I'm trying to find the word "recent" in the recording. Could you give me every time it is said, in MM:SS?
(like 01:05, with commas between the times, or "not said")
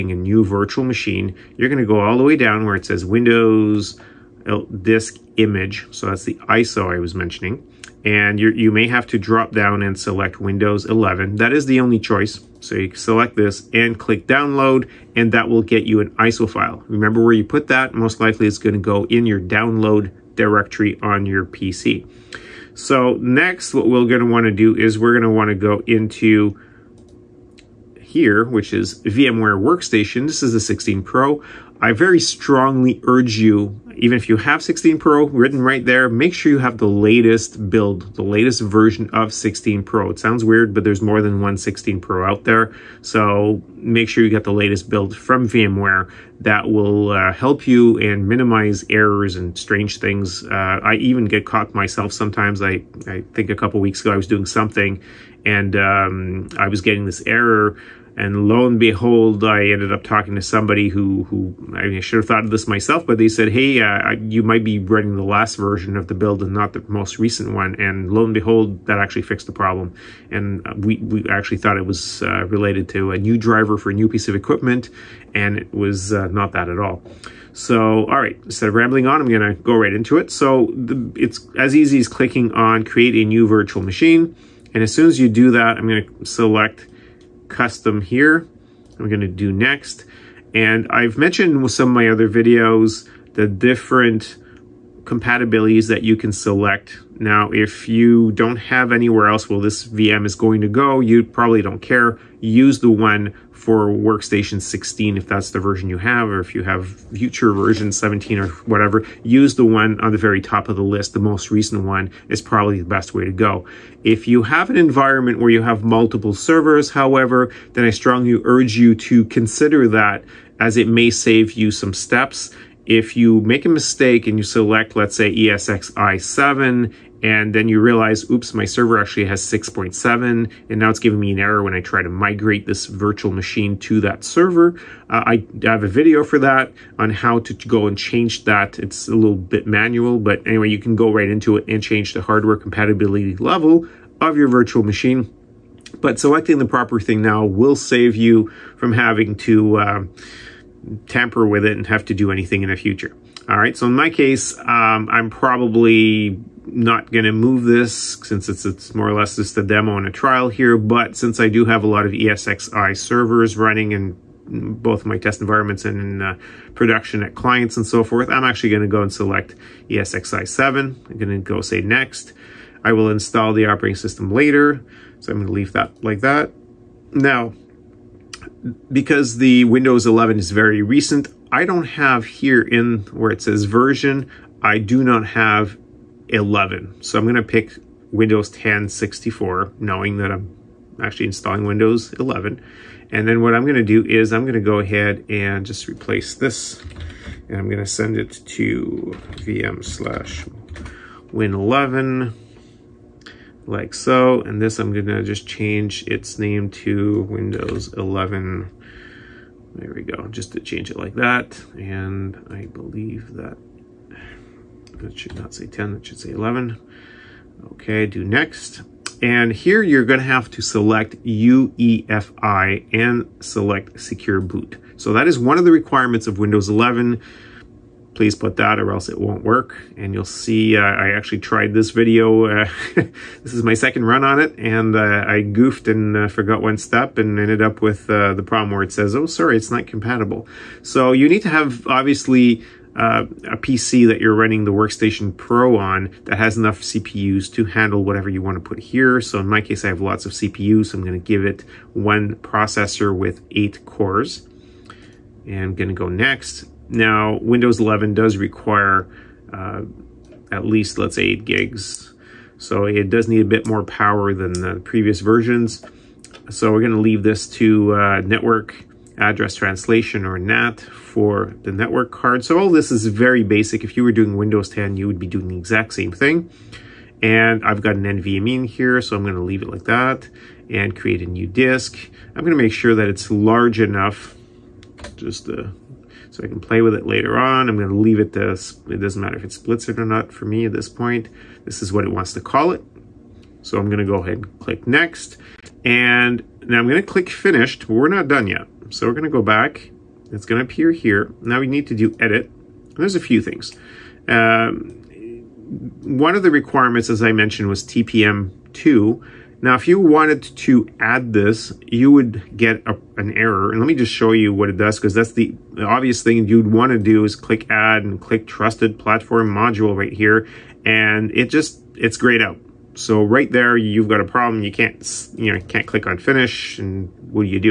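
01:07, 01:51, 03:00.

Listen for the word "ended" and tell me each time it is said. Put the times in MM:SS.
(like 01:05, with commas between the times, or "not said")
00:59, 03:57.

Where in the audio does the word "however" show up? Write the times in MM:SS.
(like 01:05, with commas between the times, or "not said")
01:56.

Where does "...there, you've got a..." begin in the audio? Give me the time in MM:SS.
05:23.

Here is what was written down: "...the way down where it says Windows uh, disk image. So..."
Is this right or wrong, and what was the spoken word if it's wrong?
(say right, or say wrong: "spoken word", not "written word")
right.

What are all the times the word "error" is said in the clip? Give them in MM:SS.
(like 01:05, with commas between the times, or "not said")
00:48, 00:57, 02:11, 05:13.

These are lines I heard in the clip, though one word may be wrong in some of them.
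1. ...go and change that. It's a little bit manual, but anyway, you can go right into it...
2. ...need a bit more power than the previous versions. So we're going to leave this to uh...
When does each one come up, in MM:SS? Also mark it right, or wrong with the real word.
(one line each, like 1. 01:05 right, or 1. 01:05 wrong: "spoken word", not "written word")
1. 02:17 right
2. 04:23 right.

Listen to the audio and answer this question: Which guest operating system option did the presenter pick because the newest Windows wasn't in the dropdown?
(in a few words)
Windows 10 64.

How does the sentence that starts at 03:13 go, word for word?
And then what I'm going to do is I'm going to go ahead and just replace this.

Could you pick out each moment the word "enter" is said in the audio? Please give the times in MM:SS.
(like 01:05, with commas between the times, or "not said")
not said.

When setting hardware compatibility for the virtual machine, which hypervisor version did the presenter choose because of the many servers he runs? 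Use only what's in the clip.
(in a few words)
ESXi 7.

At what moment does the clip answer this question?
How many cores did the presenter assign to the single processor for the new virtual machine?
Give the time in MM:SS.
04:13.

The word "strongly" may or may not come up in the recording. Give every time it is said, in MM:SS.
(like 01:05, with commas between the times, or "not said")
00:32, 01:57.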